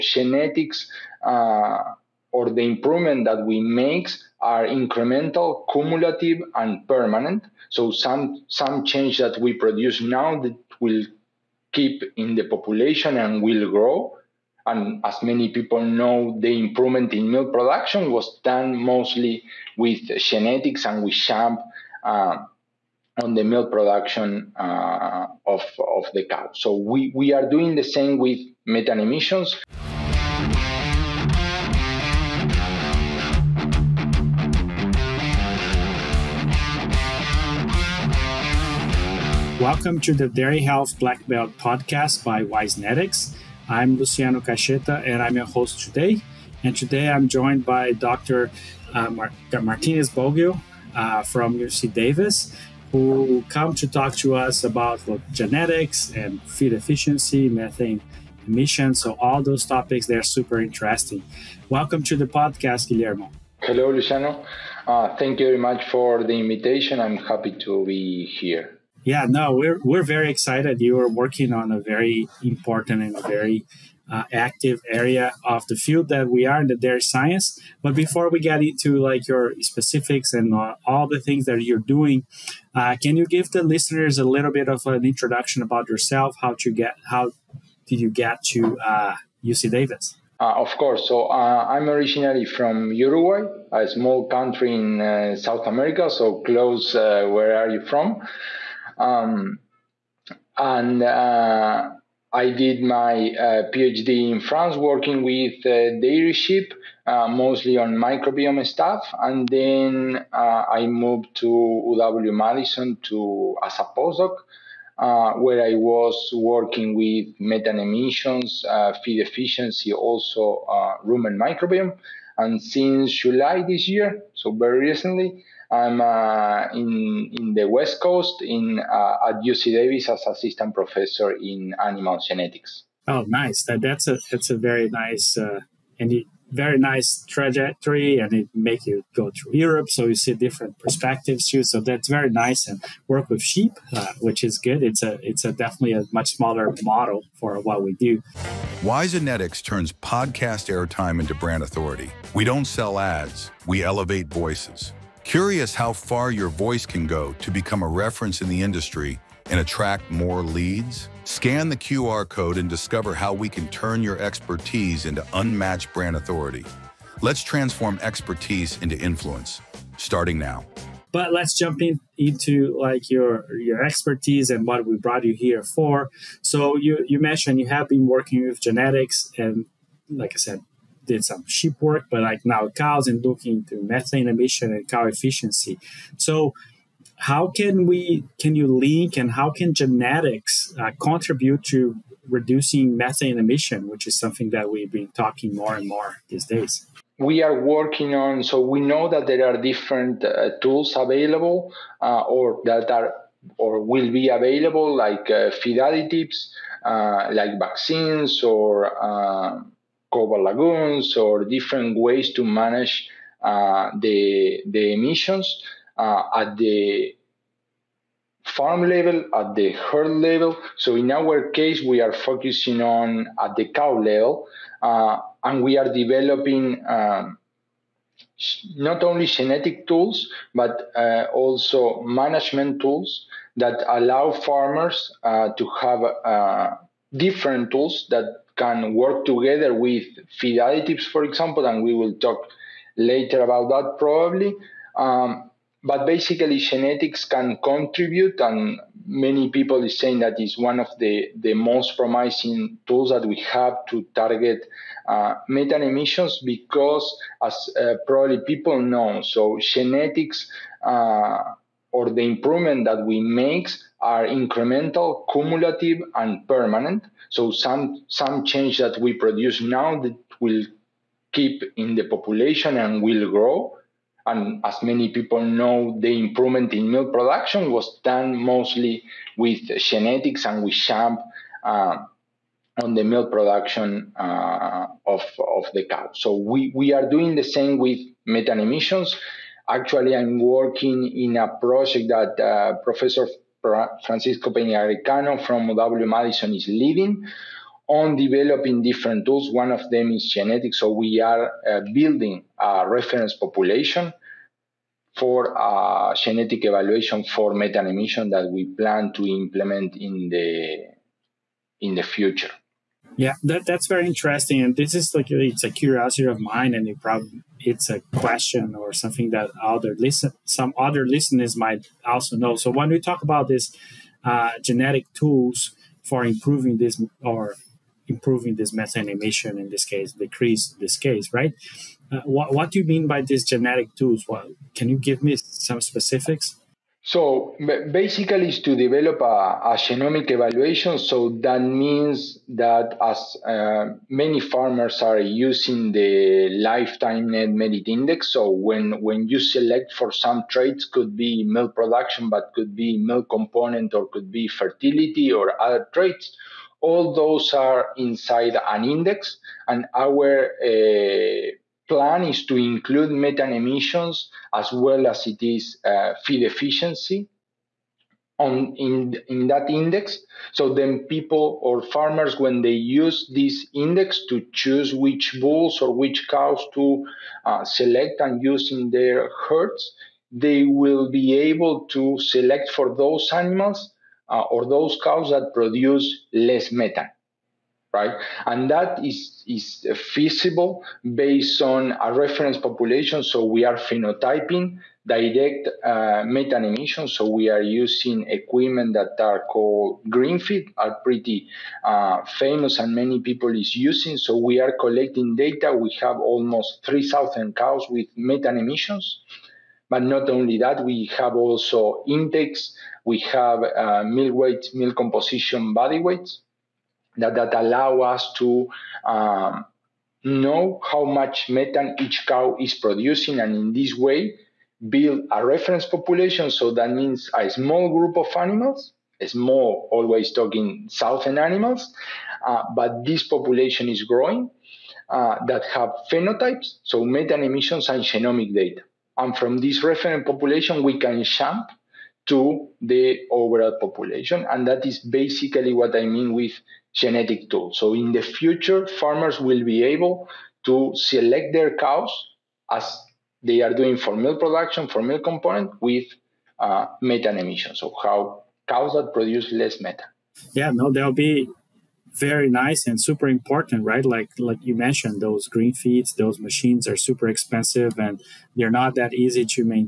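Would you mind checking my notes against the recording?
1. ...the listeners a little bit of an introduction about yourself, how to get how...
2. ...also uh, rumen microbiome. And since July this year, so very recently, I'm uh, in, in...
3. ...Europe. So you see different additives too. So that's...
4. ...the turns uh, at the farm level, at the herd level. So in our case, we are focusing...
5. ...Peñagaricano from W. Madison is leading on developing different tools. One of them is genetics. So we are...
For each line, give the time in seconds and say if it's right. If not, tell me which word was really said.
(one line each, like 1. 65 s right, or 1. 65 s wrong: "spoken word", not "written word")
1. 83 s right
2. 119 s right
3. 139 s wrong: "perspectives", not "additives"
4. 214 s wrong: "emissions", not "turns"
5. 295 s right.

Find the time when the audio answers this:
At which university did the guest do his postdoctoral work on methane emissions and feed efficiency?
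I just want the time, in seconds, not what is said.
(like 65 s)
111 s.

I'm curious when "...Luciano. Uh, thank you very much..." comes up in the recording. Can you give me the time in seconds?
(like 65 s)
63 s.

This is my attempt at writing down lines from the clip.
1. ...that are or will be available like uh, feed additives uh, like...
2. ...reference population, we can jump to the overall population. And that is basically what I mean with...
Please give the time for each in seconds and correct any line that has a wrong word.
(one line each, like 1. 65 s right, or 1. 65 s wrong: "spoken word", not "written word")
1. 202 s right
2. 439 s right.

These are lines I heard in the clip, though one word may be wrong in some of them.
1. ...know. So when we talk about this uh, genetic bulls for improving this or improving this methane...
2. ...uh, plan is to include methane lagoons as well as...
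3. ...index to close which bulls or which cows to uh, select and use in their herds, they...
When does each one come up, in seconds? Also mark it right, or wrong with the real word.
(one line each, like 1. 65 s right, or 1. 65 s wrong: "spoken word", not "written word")
1. 322 s wrong: "tools", not "bulls"
2. 360 s wrong: "emissions", not "lagoons"
3. 373 s wrong: "choose", not "close".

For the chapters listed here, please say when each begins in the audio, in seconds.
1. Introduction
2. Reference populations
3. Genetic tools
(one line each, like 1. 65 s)
1. 38 s
2. 267 s
3. 154 s.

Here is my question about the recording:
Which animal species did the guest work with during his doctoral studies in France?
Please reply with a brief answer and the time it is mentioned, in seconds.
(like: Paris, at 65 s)
Dairy sheep, at 105 s.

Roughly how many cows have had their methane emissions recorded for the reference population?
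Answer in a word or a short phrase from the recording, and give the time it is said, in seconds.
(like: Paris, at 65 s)
3,000, at 406 s.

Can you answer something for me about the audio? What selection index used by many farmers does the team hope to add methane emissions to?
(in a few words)
Lifetime net merit index.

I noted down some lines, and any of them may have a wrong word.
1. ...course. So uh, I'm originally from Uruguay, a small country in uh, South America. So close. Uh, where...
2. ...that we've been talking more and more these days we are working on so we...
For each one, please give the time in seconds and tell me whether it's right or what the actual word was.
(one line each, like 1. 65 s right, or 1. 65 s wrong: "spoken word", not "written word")
1. 90 s right
2. 194 s right.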